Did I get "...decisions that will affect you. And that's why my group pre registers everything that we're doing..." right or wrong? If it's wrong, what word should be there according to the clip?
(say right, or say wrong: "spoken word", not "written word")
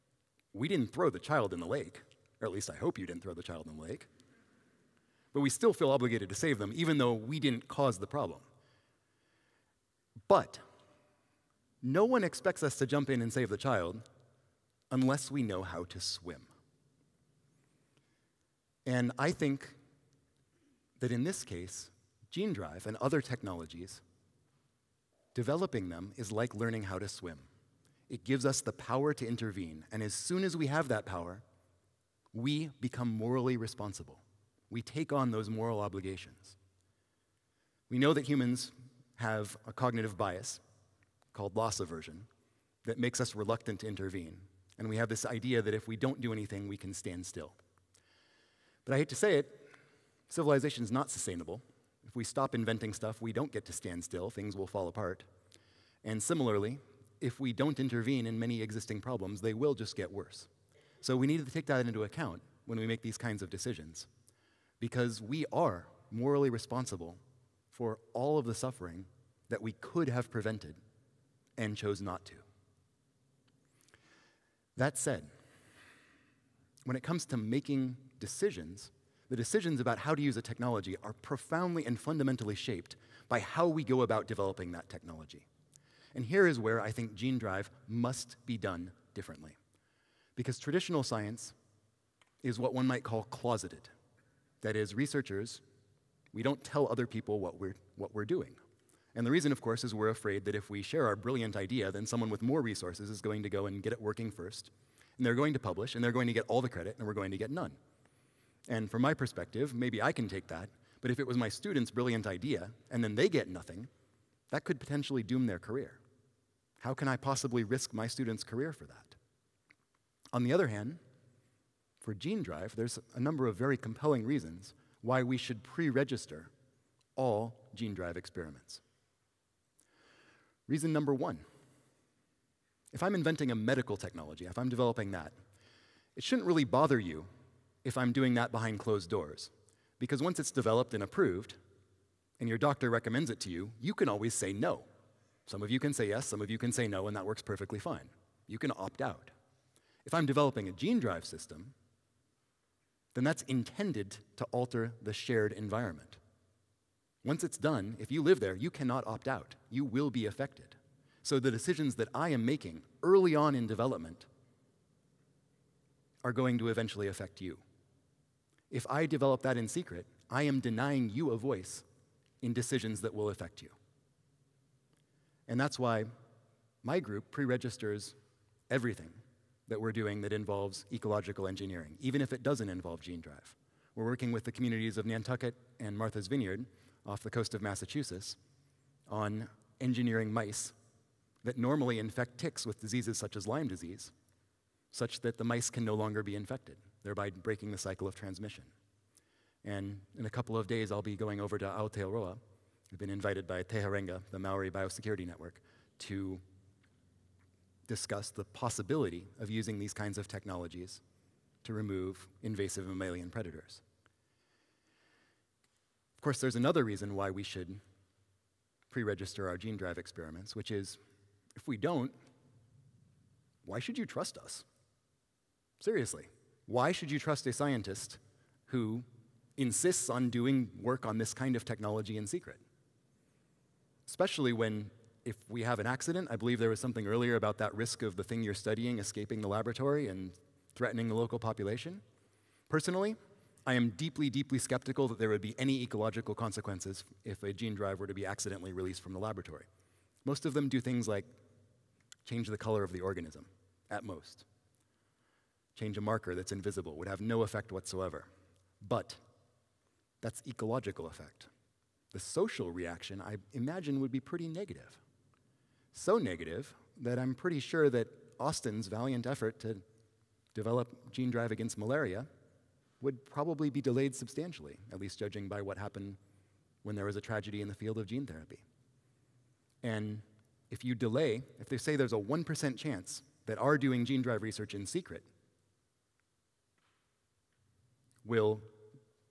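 right.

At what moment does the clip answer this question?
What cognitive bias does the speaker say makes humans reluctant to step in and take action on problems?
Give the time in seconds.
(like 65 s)
41 s.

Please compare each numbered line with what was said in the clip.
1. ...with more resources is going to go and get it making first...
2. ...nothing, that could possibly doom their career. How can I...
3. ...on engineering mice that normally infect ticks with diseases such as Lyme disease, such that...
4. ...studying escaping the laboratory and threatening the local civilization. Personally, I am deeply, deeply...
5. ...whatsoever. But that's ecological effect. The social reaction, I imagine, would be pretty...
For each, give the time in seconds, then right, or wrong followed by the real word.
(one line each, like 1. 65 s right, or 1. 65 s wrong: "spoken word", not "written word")
1. 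102 s wrong: "working", not "making"
2. 113 s wrong: "potentially", not "possibly"
3. 189 s right
4. 238 s wrong: "population", not "civilization"
5. 257 s right.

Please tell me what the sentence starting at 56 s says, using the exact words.
And similarly, if we don't intervene in many existing problems, they will just get worse.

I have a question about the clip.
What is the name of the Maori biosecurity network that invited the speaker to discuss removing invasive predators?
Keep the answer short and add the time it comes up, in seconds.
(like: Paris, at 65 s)
Teharenga, at 203 s.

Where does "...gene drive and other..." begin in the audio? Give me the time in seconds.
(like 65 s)
22 s.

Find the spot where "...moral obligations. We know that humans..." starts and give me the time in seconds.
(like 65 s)
35 s.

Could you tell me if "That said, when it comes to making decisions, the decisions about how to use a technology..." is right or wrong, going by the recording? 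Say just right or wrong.
right.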